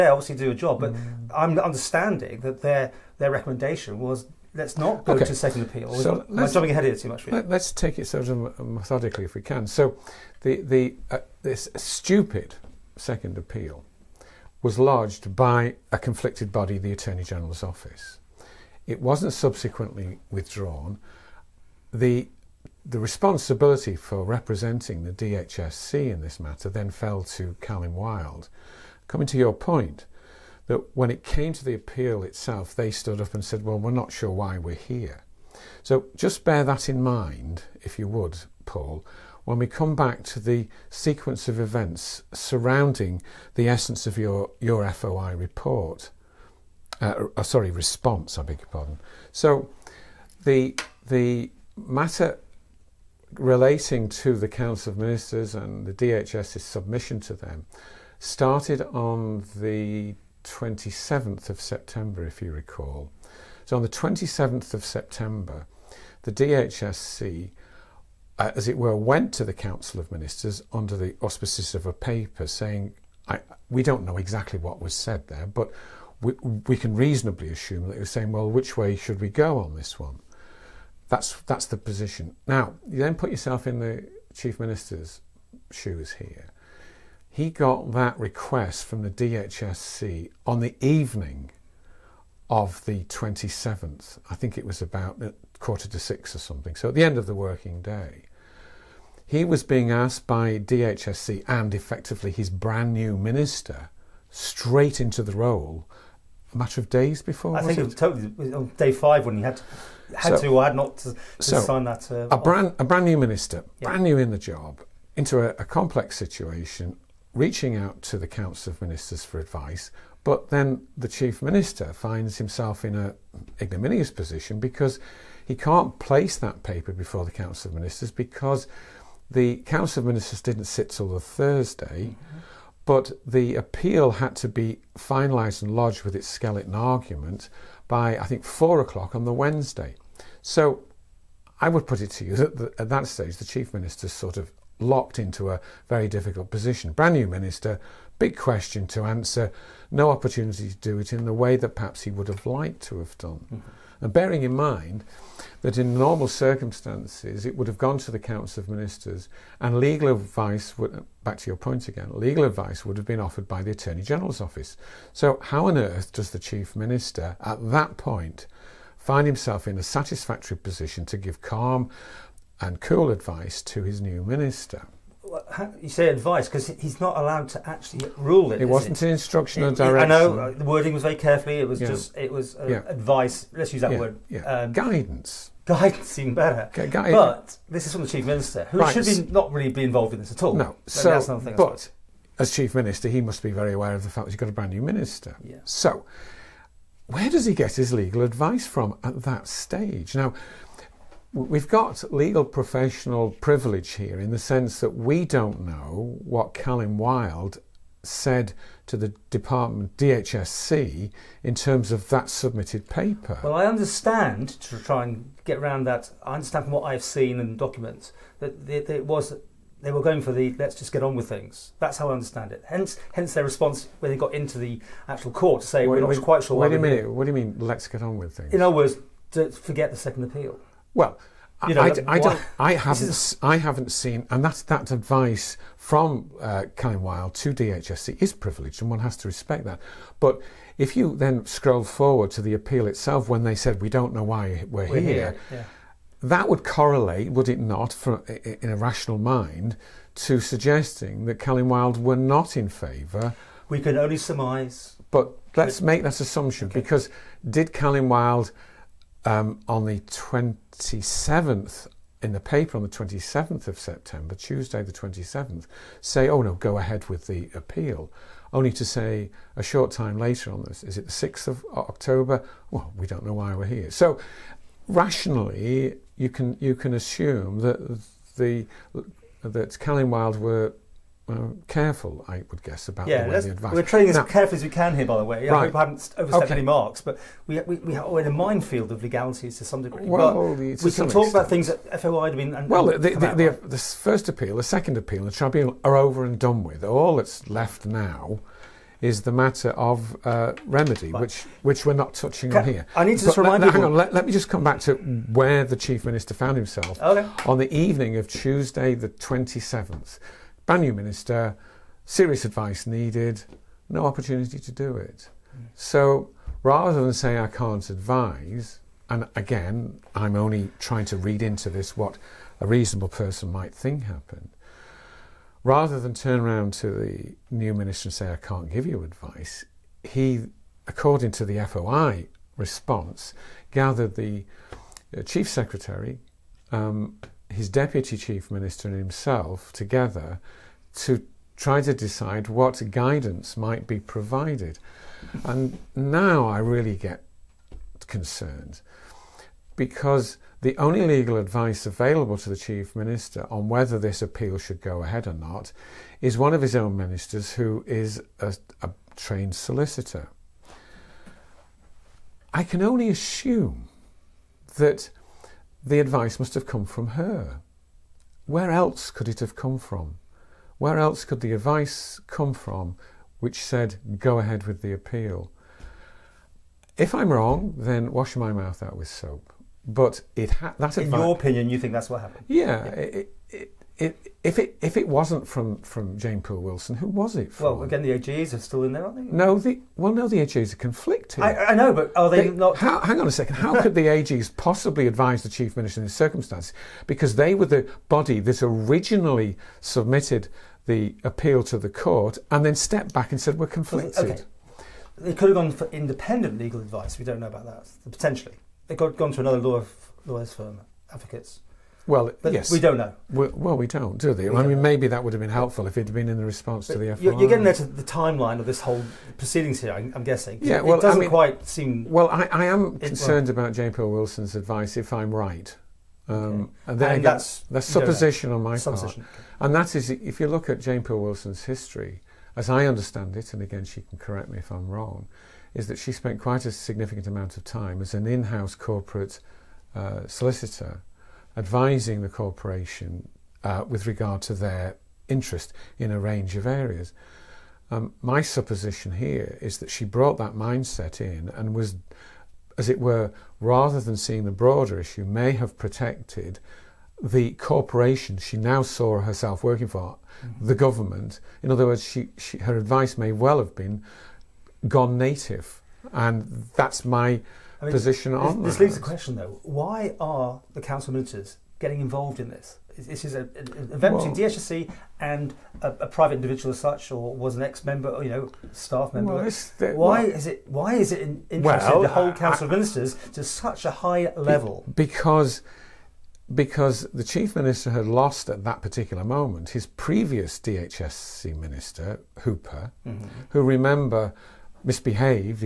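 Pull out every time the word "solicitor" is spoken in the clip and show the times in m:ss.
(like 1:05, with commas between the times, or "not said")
5:59, 7:20.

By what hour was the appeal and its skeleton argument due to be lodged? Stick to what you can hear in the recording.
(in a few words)
4 o'clock.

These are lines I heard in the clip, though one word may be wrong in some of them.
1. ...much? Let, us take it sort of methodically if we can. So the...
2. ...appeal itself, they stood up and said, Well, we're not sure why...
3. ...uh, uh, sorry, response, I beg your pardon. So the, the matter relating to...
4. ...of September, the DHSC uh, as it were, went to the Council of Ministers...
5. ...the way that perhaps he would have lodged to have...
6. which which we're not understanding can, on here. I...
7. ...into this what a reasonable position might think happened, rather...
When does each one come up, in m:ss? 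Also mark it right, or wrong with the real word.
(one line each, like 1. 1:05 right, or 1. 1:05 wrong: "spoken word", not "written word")
1. 0:07 right
2. 0:31 right
3. 0:46 right
4. 1:04 right
5. 2:31 wrong: "liked", not "lodged"
6. 5:01 wrong: "touching", not "understanding"
7. 5:21 wrong: "person", not "position".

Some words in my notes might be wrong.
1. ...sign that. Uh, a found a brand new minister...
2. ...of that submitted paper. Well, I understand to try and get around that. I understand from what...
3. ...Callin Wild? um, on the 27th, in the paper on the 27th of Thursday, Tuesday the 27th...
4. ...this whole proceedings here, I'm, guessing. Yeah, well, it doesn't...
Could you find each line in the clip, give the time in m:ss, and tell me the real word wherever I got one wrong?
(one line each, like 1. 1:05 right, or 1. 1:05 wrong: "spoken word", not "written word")
1. 1:51 wrong: "brand", not "found"
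2. 3:31 right
3. 4:17 wrong: "September", not "Thursday"
4. 6:58 right.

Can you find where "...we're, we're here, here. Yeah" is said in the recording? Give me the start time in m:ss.
4:04.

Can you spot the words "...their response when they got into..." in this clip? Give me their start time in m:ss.
3:43.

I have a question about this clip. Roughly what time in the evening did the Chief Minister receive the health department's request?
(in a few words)
5:45.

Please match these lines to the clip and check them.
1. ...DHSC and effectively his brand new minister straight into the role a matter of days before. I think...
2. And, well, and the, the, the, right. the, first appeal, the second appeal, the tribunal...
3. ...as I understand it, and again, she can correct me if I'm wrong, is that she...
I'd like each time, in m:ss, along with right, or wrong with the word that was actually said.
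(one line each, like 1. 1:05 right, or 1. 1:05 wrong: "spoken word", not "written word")
1. 1:40 right
2. 4:52 right
3. 7:12 right.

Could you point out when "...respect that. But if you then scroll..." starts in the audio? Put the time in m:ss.
3:59.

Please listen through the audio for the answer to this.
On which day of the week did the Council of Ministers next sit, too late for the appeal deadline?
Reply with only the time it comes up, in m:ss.
2:11.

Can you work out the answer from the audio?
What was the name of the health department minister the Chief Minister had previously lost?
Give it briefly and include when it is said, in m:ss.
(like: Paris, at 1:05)
Hooper, at 8:12.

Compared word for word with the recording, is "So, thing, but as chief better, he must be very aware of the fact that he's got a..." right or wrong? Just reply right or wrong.
wrong.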